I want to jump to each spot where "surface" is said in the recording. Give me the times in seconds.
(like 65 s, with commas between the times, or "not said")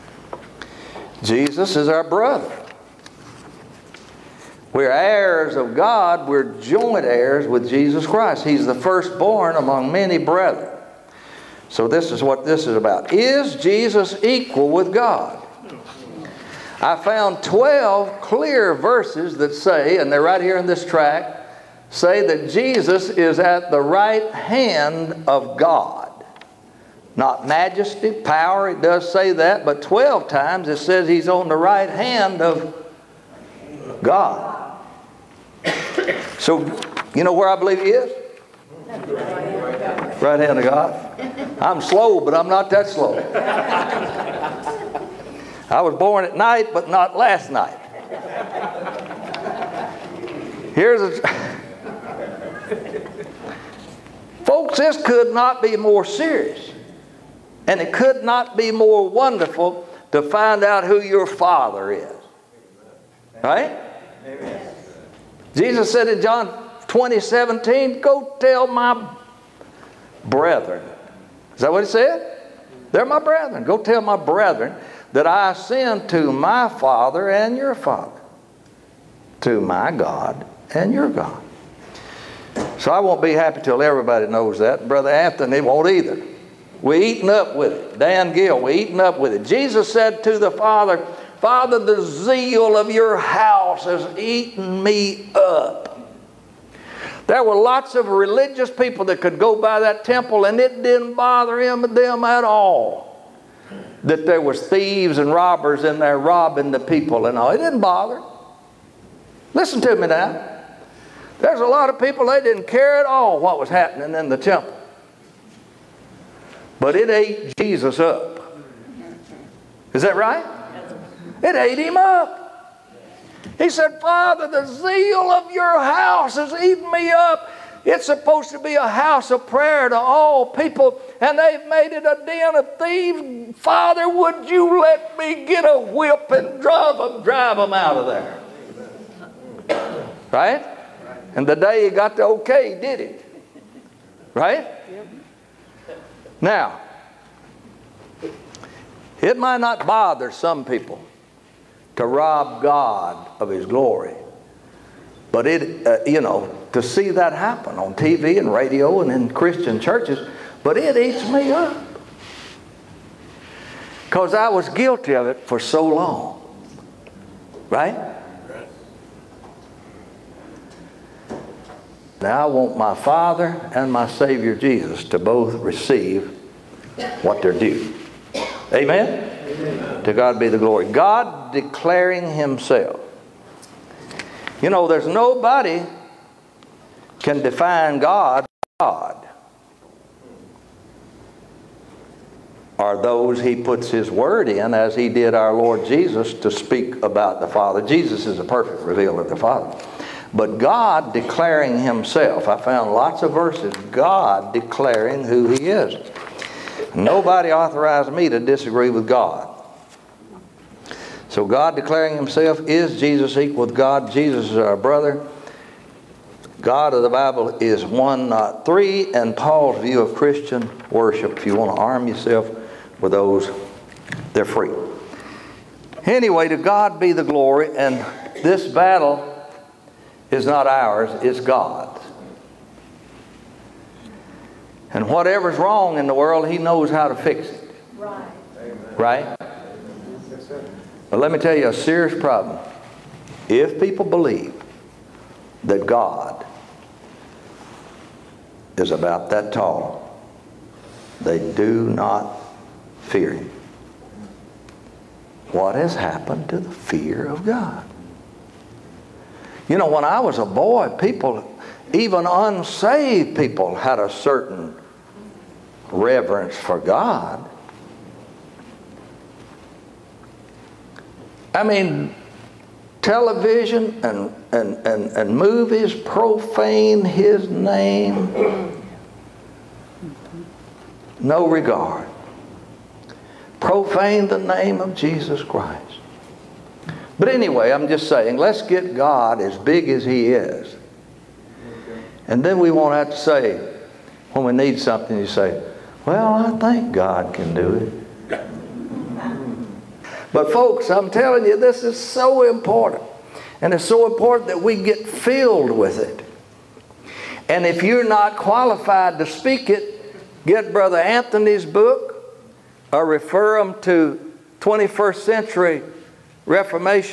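not said.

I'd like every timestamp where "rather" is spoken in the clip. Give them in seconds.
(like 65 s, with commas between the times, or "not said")
not said.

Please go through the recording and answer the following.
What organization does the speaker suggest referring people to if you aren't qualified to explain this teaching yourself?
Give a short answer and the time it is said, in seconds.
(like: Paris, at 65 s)
21st Century Reformation, at 314 s.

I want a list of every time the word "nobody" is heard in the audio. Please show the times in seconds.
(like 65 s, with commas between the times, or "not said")
185 s, 206 s.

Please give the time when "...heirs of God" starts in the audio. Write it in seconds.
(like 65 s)
4 s.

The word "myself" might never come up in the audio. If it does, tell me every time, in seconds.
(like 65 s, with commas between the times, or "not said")
not said.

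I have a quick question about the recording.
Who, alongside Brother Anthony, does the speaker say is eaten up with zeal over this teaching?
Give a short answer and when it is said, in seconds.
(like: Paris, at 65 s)
Dan Gill, at 87 s.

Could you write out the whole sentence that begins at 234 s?
And whatever's wrong in the world, He knows how to fix it.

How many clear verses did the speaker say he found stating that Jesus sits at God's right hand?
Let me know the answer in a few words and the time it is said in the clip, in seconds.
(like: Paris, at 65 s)
12, at 17 s.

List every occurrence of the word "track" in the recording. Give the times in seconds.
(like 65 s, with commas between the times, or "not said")
20 s.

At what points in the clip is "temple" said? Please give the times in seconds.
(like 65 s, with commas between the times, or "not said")
100 s, 114 s.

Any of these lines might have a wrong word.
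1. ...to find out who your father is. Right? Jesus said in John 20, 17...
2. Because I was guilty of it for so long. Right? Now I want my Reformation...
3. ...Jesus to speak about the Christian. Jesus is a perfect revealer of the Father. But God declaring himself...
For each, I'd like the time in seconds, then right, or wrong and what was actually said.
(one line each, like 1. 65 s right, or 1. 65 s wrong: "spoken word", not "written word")
1. 60 s right
2. 164 s wrong: "Father", not "Reformation"
3. 195 s wrong: "Father", not "Christian".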